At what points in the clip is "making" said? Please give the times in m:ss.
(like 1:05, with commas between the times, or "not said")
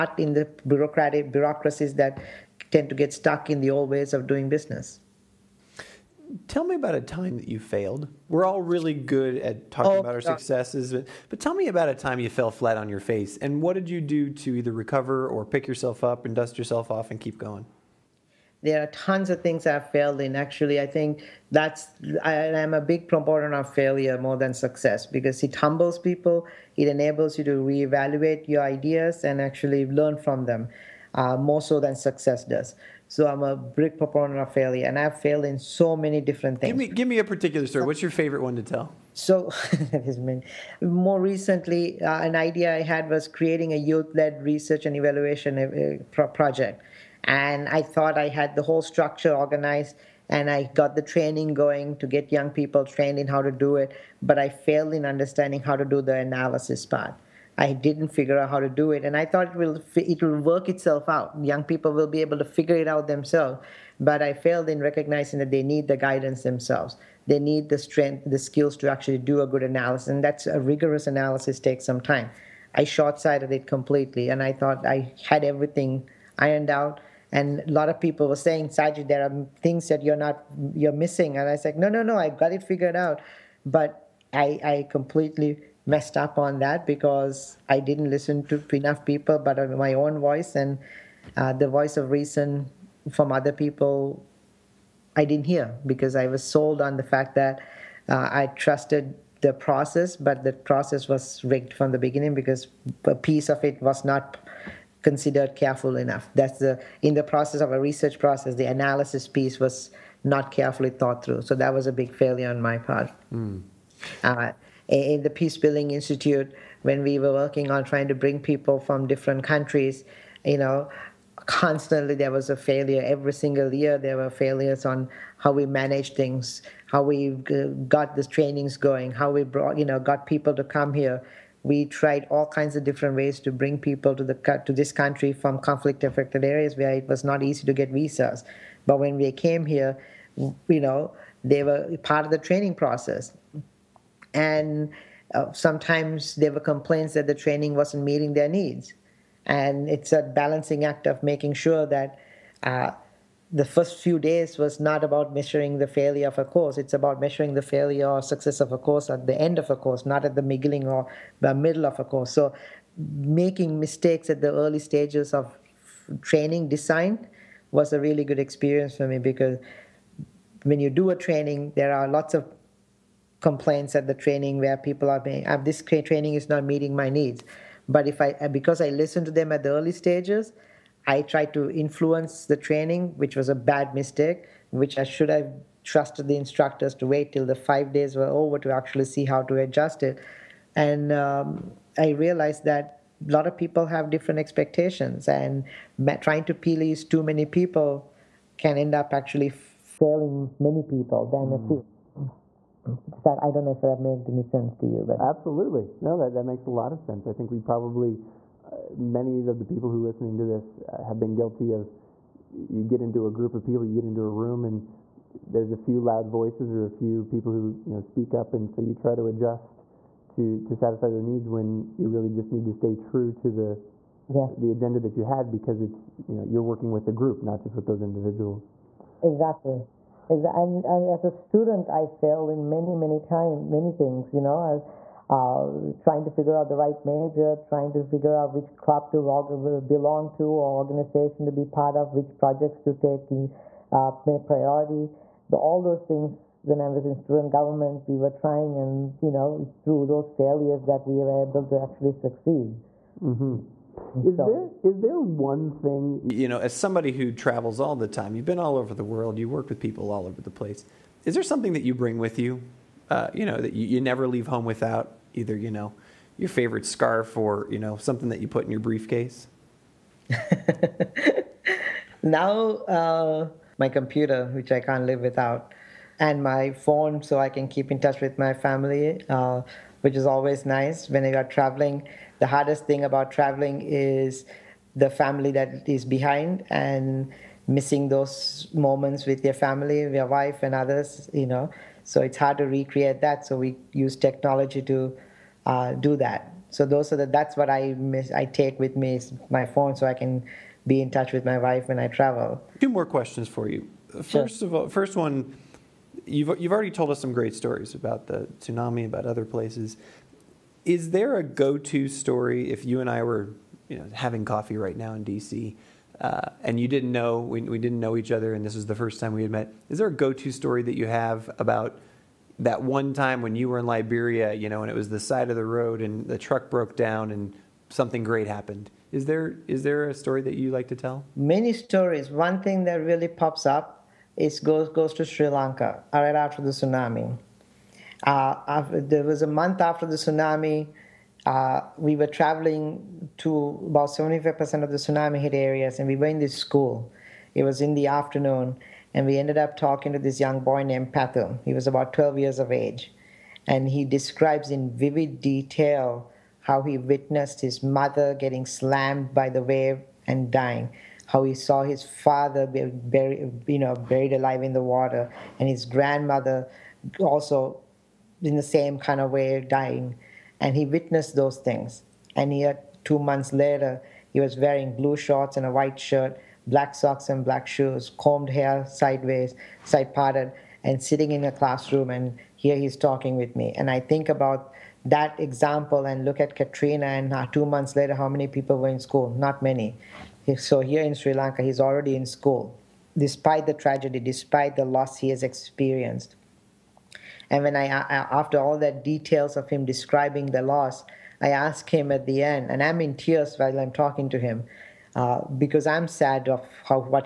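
2:31, 2:43.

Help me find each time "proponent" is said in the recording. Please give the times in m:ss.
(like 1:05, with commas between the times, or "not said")
0:23, 0:33.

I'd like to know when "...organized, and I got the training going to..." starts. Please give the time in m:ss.
0:49.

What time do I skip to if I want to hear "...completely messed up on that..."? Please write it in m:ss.
1:24.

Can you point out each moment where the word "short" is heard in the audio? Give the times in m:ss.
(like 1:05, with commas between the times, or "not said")
1:12, 6:15.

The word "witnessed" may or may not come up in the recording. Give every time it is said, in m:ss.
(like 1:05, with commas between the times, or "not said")
5:56, 6:10.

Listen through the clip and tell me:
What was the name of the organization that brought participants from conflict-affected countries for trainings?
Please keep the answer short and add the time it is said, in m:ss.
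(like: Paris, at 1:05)
Peace Building Institute, at 1:55.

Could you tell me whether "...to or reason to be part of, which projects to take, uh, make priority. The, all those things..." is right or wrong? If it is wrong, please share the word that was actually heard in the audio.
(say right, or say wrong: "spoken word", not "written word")
wrong: "organization", not "reason".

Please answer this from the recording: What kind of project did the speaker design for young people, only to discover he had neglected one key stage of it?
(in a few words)
youth-led research and evaluation.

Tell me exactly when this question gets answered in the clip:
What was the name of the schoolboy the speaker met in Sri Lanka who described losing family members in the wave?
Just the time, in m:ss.
5:51.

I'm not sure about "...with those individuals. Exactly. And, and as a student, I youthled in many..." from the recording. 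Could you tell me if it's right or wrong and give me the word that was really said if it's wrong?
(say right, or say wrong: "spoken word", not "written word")
wrong: "failed", not "youthled".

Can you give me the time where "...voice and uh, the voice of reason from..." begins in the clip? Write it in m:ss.
1:30.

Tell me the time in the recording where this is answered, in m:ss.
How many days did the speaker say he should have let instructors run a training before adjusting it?
3:07.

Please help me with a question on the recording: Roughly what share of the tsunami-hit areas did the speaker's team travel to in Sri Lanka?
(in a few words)
75%.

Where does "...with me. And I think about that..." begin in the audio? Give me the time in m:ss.
6:23.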